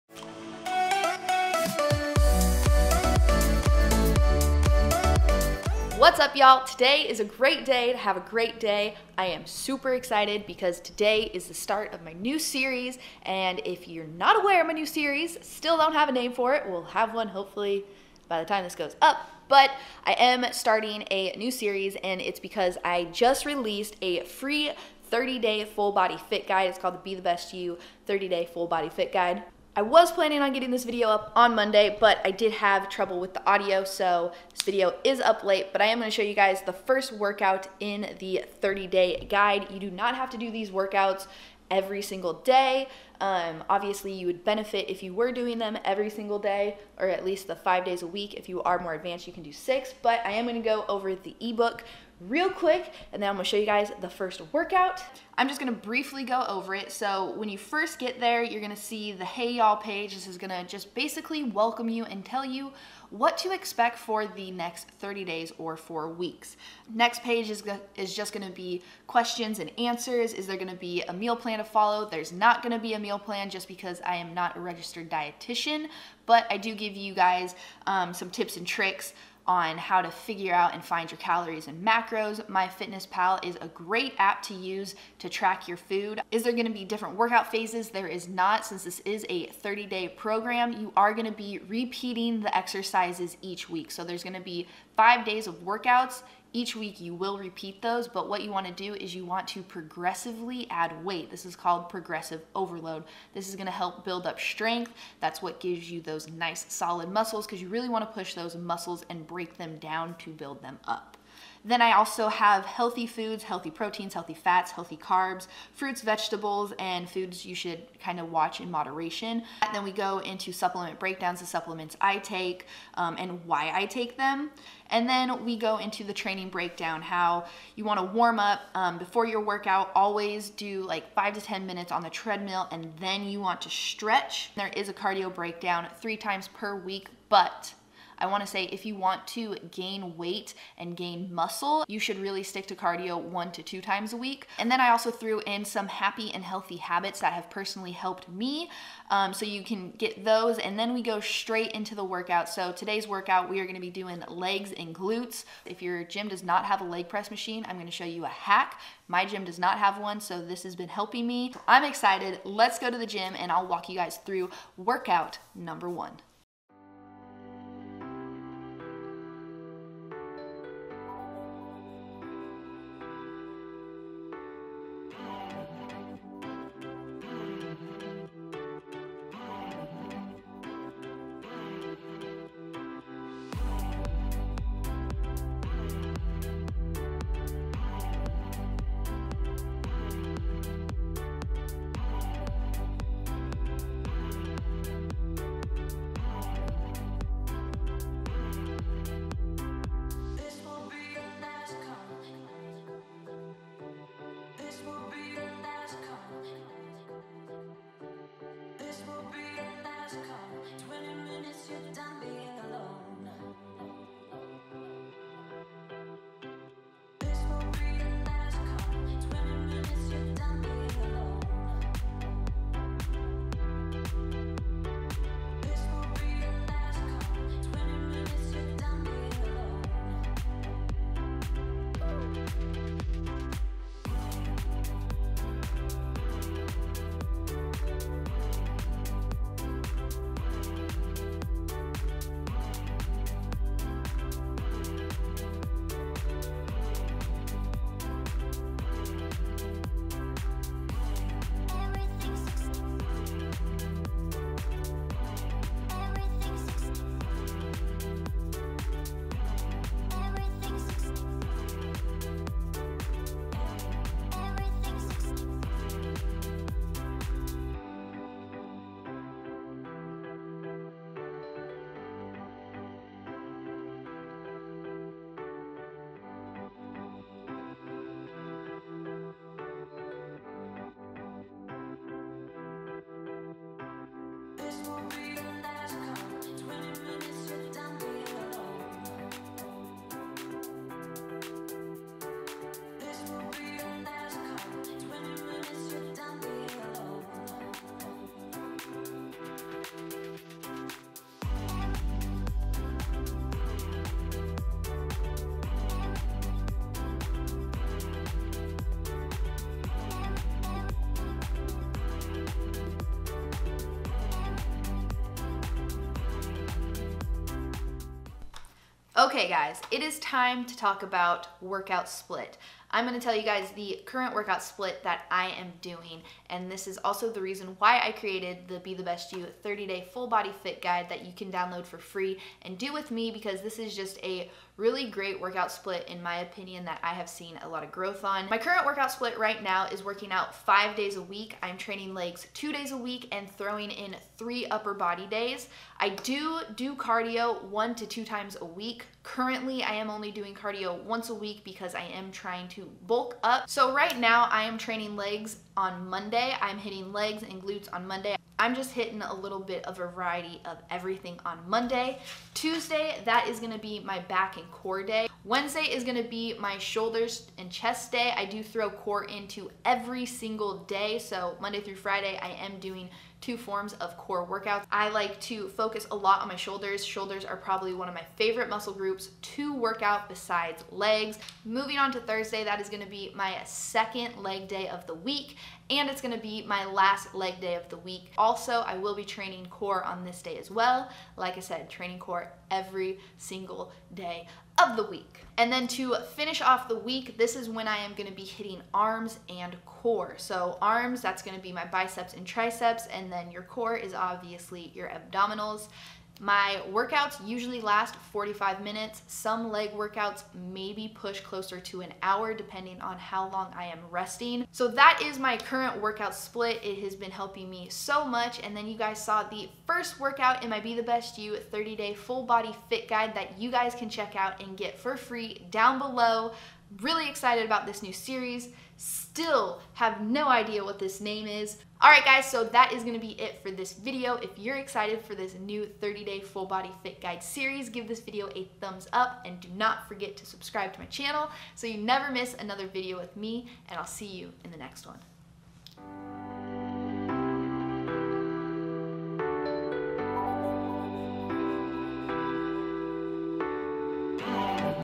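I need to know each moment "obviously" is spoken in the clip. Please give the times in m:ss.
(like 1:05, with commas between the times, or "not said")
0:43, 6:44.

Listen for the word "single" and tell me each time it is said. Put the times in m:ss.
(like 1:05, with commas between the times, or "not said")
0:42, 0:46, 6:10, 6:33.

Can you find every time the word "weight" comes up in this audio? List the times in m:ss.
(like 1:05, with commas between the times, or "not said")
1:41, 2:20.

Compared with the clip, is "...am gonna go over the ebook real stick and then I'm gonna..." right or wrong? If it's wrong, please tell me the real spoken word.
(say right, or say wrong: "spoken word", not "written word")
wrong: "quick", not "stick".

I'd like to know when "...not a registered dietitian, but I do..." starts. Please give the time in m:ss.
1:14.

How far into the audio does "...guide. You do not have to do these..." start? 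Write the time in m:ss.
0:39.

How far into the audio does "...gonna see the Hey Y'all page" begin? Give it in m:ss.
0:58.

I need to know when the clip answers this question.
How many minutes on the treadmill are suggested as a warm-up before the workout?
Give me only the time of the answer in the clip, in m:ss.
2:11.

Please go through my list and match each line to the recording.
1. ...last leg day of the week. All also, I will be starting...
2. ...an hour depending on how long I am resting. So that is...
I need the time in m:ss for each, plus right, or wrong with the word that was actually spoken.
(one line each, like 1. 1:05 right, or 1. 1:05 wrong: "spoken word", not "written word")
1. 6:26 wrong: "training", not "starting"
2. 6:52 right.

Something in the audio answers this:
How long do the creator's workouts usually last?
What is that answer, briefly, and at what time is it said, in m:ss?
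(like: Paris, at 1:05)
45 minutes, at 6:48.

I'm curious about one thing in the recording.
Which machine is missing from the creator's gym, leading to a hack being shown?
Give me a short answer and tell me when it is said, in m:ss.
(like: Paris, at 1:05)
Leg press machine, at 2:36.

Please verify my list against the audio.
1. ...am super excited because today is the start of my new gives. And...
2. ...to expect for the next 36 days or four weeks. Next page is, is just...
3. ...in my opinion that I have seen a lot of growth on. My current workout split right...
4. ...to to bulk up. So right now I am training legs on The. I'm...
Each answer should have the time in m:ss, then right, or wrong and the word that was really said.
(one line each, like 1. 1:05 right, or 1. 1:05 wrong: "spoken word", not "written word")
1. 0:09 wrong: "series", not "gives"
2. 1:03 wrong: "30", not "36"
3. 5:36 right
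4. 5:52 wrong: "Monday", not "The".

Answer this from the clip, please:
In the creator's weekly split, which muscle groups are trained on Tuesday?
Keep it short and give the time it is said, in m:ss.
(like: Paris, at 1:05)
Back and core, at 6:04.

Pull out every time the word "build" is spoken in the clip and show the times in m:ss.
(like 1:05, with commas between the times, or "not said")
1:44, 1:50.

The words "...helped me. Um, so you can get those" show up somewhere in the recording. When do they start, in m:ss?
2:27.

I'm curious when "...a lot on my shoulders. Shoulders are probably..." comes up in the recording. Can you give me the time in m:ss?
6:16.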